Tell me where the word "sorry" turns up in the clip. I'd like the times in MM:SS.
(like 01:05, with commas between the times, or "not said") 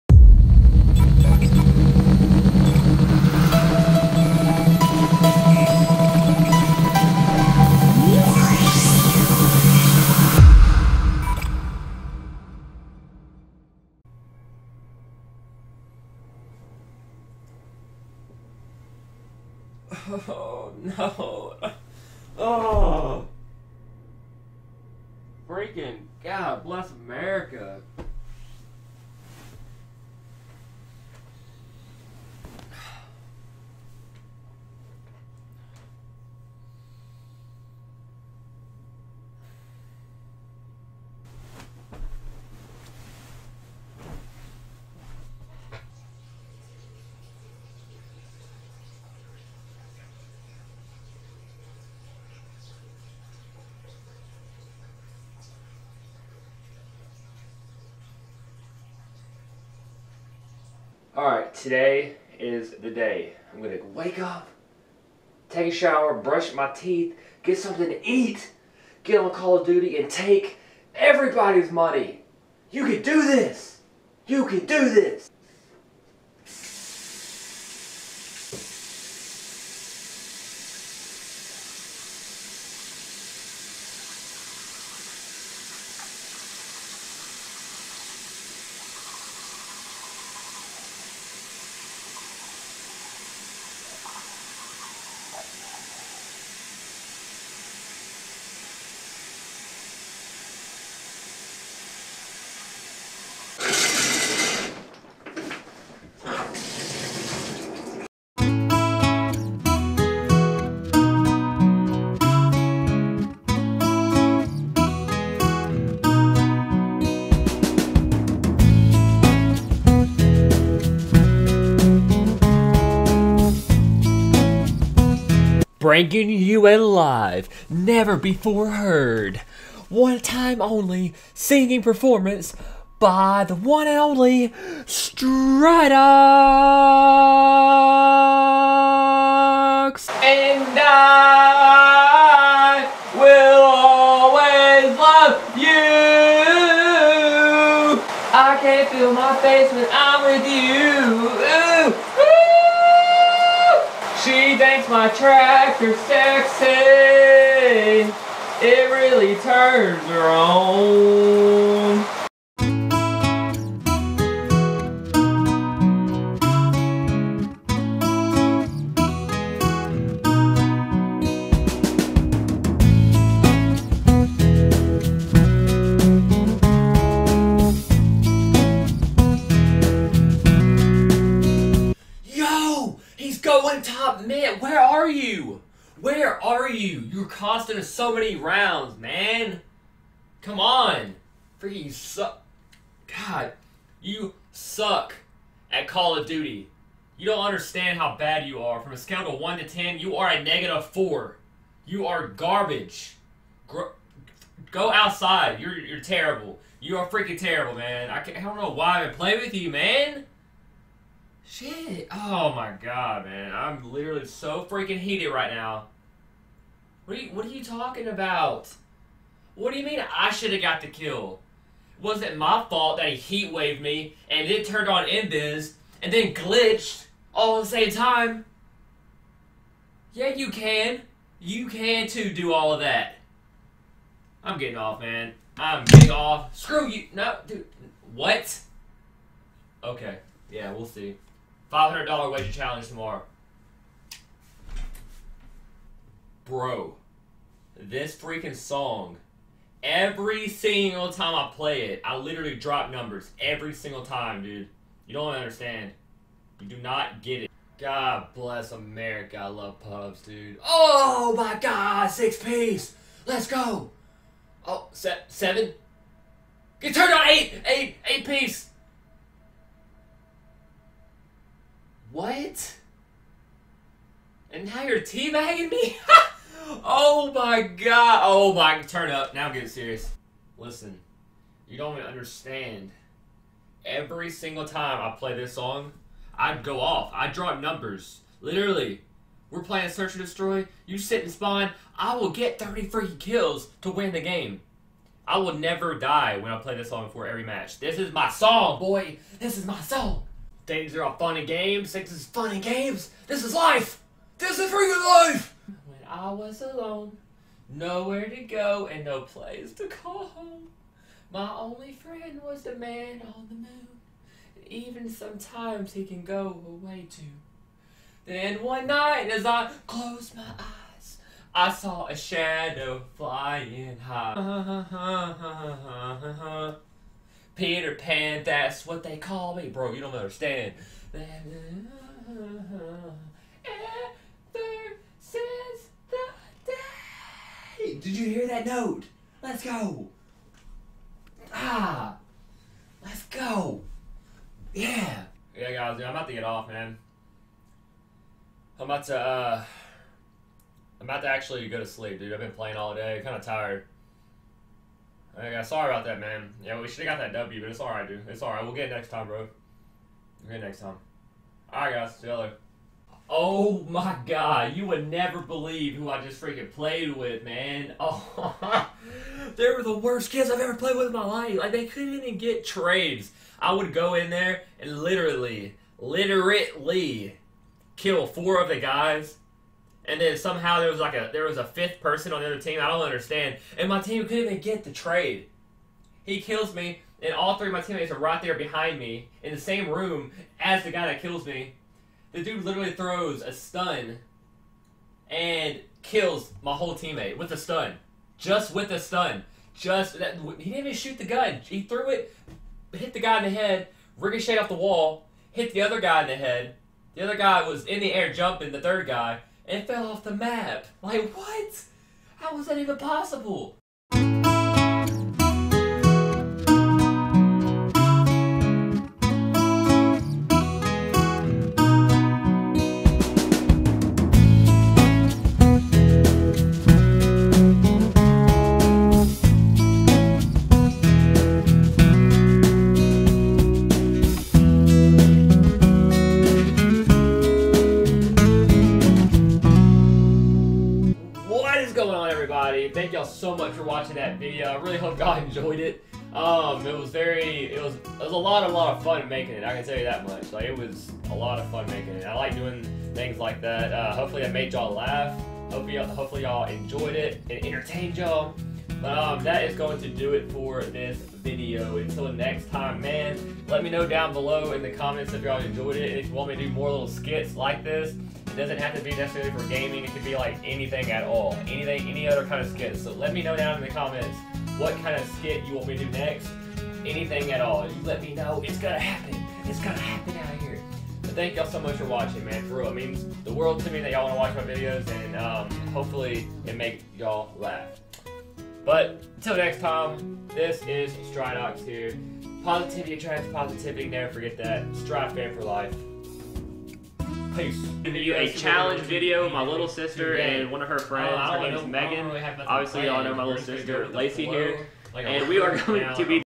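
05:55.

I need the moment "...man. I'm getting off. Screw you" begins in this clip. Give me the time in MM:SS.
03:55.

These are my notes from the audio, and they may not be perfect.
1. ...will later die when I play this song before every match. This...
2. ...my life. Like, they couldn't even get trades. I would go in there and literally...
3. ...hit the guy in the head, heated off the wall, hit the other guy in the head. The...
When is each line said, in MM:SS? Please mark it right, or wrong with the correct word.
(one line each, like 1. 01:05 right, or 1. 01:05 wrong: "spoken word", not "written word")
1. 04:55 wrong: "never", not "later"
2. 06:11 right
3. 06:42 wrong: "ricocheted", not "heated".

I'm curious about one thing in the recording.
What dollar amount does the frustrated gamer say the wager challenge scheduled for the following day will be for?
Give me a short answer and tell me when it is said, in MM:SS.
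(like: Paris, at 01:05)
$500, at 04:01.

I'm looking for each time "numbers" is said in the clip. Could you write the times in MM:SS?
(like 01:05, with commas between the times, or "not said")
04:12, 04:47.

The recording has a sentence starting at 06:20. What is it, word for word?
And then somehow there was like a there was a fifth person on the other team.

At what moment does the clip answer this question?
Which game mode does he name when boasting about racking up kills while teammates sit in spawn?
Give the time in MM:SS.
04:49.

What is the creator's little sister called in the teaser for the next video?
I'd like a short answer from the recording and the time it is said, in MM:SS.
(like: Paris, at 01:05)
Lacey, at 08:24.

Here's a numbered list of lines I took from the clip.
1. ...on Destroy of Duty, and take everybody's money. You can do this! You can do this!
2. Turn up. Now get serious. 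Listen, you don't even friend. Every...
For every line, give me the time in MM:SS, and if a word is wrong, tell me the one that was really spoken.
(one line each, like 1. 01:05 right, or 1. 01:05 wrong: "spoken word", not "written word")
1. 01:09 wrong: "Call", not "Destroy"
2. 04:38 wrong: "understand", not "friend".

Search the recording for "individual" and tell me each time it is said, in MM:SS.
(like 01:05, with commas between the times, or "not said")
not said.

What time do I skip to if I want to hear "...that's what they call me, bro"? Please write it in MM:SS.
05:28.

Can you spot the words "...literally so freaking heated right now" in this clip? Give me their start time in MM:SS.
03:33.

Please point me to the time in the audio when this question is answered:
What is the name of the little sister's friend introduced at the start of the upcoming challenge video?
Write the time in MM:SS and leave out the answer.
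08:21.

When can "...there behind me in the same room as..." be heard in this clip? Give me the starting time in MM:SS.
06:28.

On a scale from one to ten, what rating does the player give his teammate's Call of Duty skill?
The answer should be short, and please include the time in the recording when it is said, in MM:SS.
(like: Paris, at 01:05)
-4, at 03:20.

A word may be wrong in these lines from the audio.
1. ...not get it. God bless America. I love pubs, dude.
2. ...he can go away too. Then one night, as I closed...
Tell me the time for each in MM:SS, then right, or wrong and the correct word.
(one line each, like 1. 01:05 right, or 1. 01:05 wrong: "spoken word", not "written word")
1. 04:16 right
2. 05:15 right.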